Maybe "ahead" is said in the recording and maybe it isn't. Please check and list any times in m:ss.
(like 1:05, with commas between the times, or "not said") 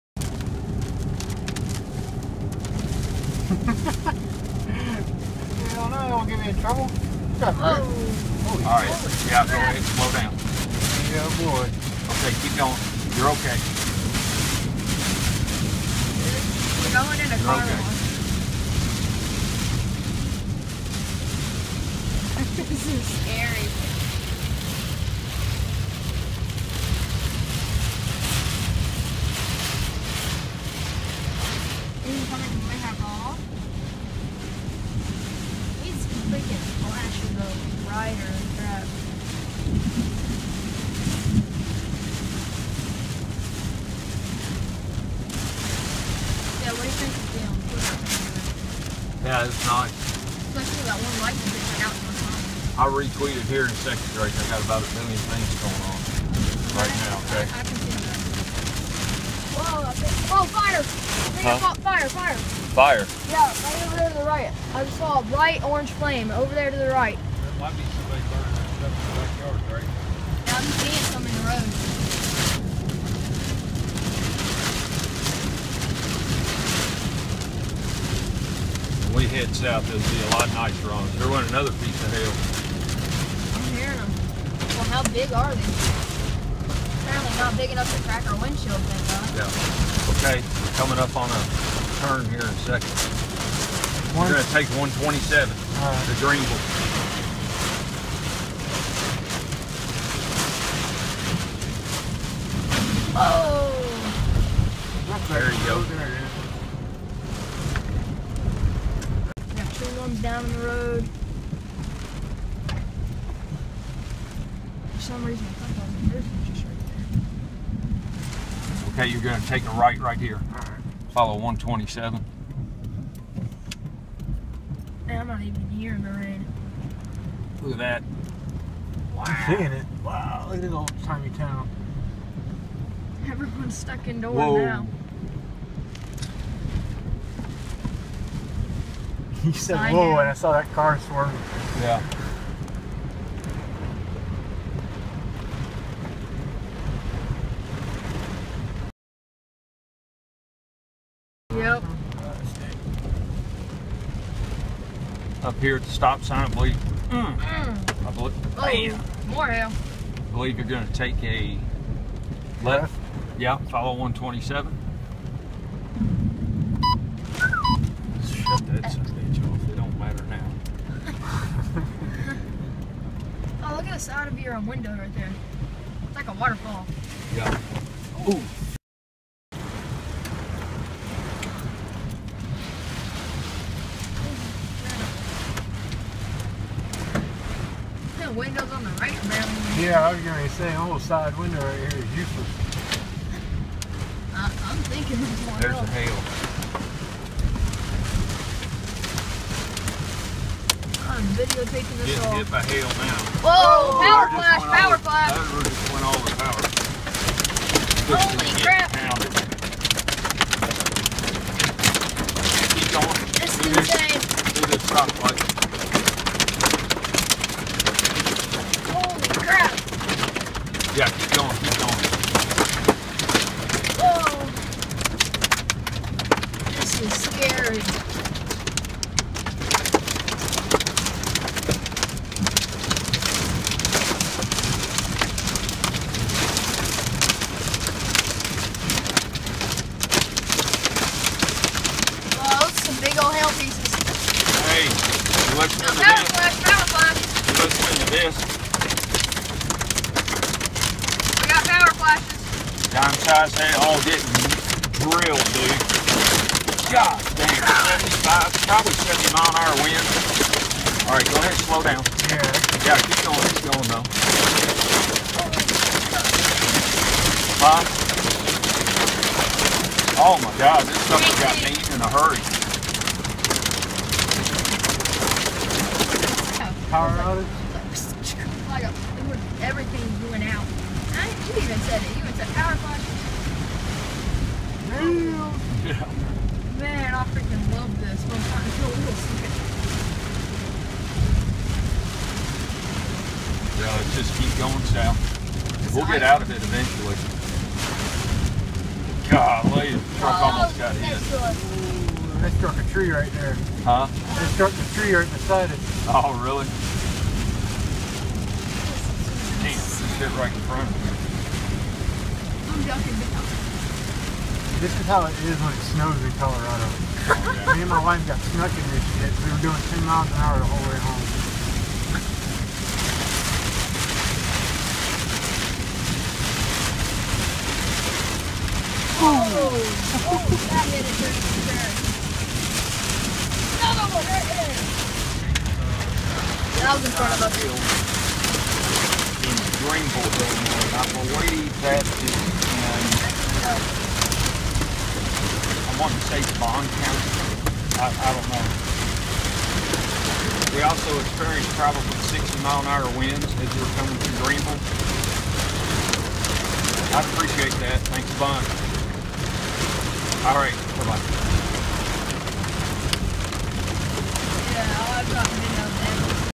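0:09, 4:21.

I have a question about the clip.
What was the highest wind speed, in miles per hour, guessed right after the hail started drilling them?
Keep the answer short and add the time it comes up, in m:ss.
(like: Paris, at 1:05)
75, at 4:18.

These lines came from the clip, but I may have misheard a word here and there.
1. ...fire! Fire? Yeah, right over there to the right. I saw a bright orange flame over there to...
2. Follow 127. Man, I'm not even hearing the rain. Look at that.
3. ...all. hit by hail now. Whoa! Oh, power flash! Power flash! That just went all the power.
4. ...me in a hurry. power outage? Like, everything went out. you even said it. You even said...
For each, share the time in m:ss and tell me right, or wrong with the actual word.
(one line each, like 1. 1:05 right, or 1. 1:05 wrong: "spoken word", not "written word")
1. 1:02 right
2. 2:01 right
3. 3:22 right
4. 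4:31 right.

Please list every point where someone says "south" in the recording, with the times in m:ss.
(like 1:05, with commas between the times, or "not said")
1:19, 4:54.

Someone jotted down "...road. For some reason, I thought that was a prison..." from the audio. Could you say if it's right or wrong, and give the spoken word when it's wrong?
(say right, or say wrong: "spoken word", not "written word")
right.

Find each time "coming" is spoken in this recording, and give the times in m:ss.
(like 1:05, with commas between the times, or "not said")
1:30, 5:53.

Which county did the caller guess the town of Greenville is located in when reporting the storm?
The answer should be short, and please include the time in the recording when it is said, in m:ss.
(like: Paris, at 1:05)
Bond County, at 5:46.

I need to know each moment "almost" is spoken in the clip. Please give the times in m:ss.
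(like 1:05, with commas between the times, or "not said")
3:10, 5:00.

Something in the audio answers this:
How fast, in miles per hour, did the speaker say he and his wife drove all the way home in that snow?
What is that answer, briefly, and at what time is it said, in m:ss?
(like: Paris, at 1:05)
10, at 5:19.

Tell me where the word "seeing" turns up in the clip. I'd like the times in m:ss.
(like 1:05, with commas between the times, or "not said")
1:10, 2:09.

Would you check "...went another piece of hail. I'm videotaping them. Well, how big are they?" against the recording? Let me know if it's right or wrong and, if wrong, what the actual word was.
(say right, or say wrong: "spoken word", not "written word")
wrong: "hearing", not "videotaping".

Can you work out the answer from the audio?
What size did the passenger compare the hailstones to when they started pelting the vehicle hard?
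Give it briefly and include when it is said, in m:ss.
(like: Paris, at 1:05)
Dime size, at 4:12.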